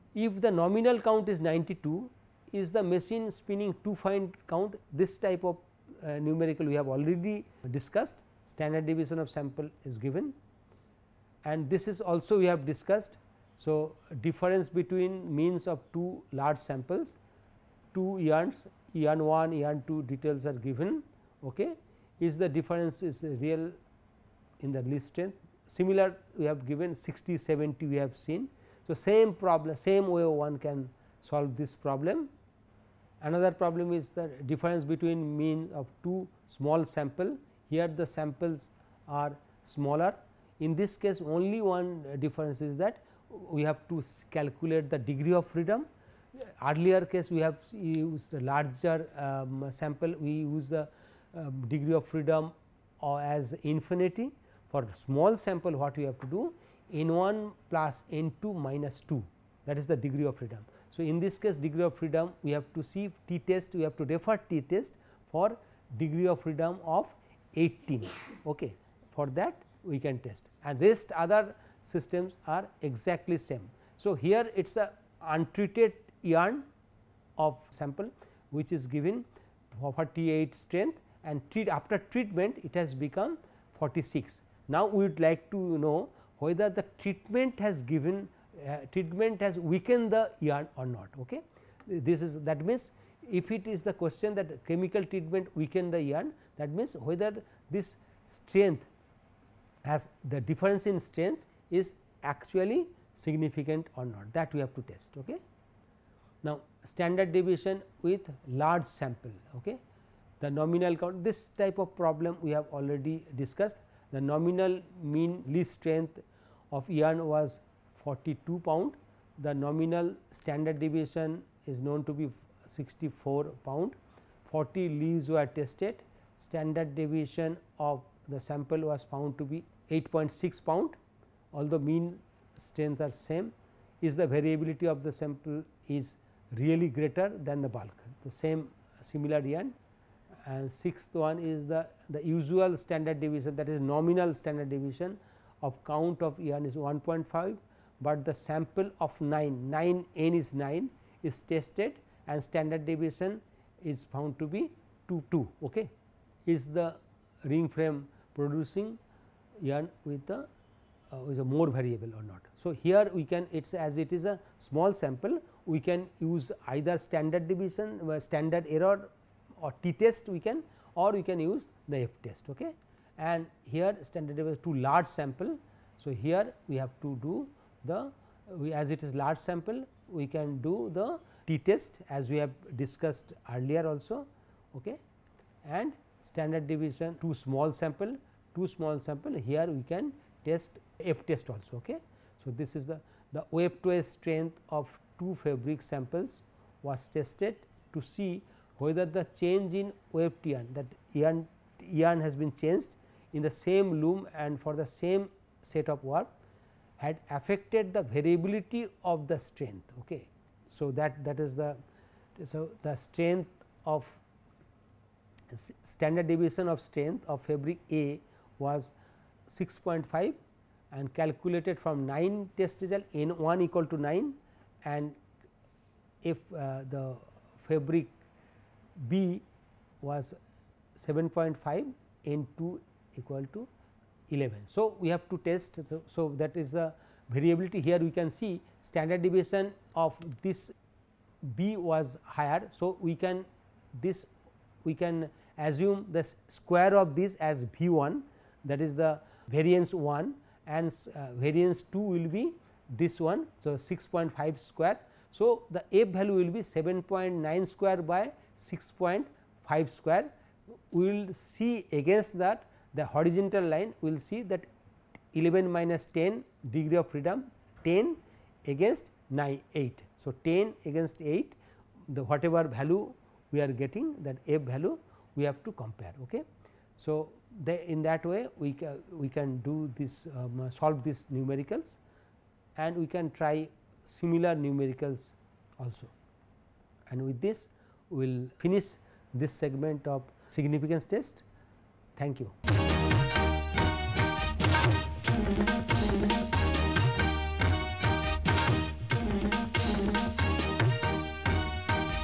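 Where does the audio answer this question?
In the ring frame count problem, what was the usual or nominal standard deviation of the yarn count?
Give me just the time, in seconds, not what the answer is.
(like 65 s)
146 s.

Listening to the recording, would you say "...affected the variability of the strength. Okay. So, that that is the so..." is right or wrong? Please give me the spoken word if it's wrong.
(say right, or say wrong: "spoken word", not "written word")
right.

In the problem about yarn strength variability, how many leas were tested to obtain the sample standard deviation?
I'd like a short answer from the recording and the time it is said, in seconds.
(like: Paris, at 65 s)
40, at 124 s.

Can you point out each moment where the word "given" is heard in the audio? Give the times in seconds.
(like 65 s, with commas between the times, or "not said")
9 s, 20 s, 26 s, 78 s, 87 s.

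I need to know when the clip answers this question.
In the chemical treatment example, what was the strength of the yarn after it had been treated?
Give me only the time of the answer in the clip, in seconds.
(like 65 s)
83 s.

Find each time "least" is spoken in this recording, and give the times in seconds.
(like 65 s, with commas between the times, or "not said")
24 s, 115 s.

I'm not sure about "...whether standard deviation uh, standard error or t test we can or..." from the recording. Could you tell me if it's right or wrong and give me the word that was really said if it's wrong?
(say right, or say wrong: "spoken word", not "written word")
wrong: "either", not "whether".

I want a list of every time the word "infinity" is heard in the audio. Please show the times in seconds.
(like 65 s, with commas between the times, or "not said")
53 s.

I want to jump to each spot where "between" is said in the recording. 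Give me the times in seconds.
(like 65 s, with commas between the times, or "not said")
14 s, 34 s.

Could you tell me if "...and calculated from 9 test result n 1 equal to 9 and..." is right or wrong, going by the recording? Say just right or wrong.
right.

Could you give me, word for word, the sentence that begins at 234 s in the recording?
So, we have to test so, so that is the variability here we can see standard deviation of this b was higher.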